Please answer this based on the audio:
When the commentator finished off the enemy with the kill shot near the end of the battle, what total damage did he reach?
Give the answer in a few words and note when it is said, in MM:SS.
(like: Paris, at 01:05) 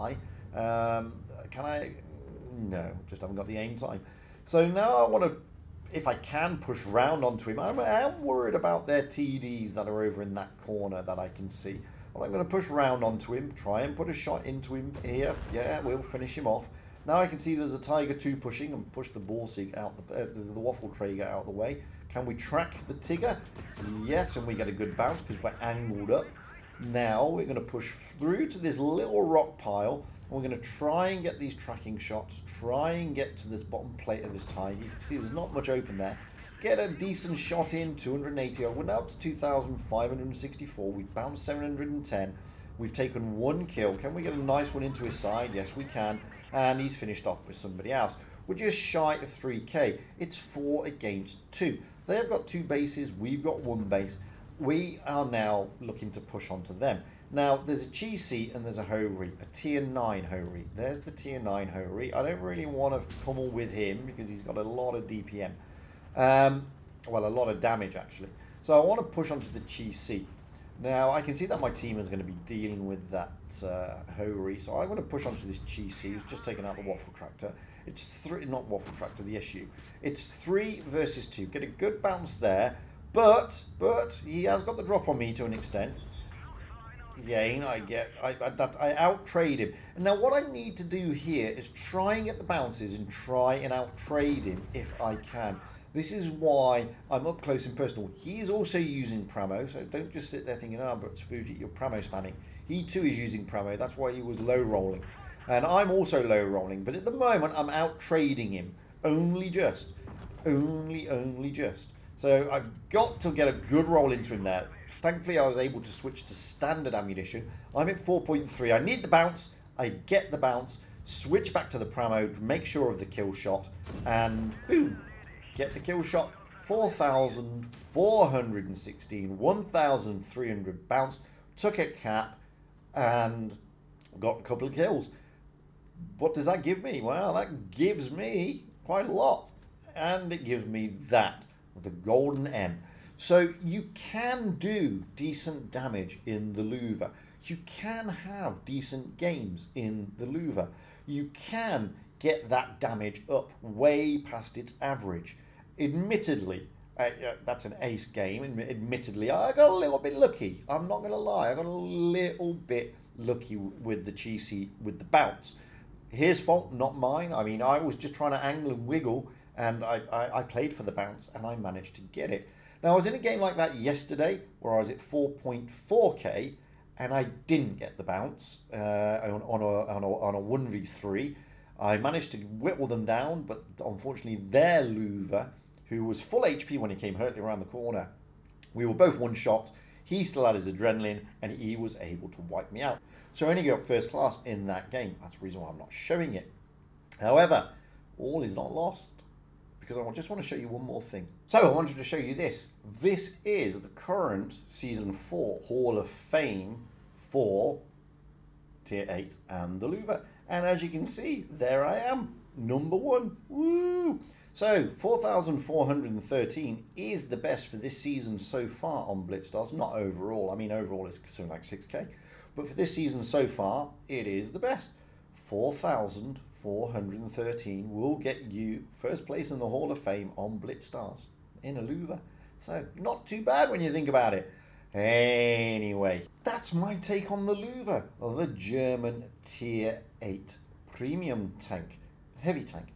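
4,416, at 02:06.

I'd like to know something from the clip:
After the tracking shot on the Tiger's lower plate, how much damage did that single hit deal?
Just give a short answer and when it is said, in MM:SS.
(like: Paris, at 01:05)
280, at 00:37.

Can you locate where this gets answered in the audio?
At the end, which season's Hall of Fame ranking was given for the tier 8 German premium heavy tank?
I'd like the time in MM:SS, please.
03:24.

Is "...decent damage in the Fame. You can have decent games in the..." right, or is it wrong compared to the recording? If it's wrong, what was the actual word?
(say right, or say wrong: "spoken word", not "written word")
wrong: "Lowe", not "Fame".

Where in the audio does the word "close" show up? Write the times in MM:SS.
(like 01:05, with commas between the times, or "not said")
01:37.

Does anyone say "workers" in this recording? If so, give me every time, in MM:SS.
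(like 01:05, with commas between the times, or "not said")
not said.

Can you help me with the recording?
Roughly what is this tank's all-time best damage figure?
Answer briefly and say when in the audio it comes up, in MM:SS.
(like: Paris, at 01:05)
6k, at 03:41.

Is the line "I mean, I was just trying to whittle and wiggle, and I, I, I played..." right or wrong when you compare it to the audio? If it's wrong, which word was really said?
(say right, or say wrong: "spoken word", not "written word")
wrong: "angle", not "whittle".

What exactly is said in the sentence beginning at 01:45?
And I'm also low rolling, but at the moment I'm out trading him.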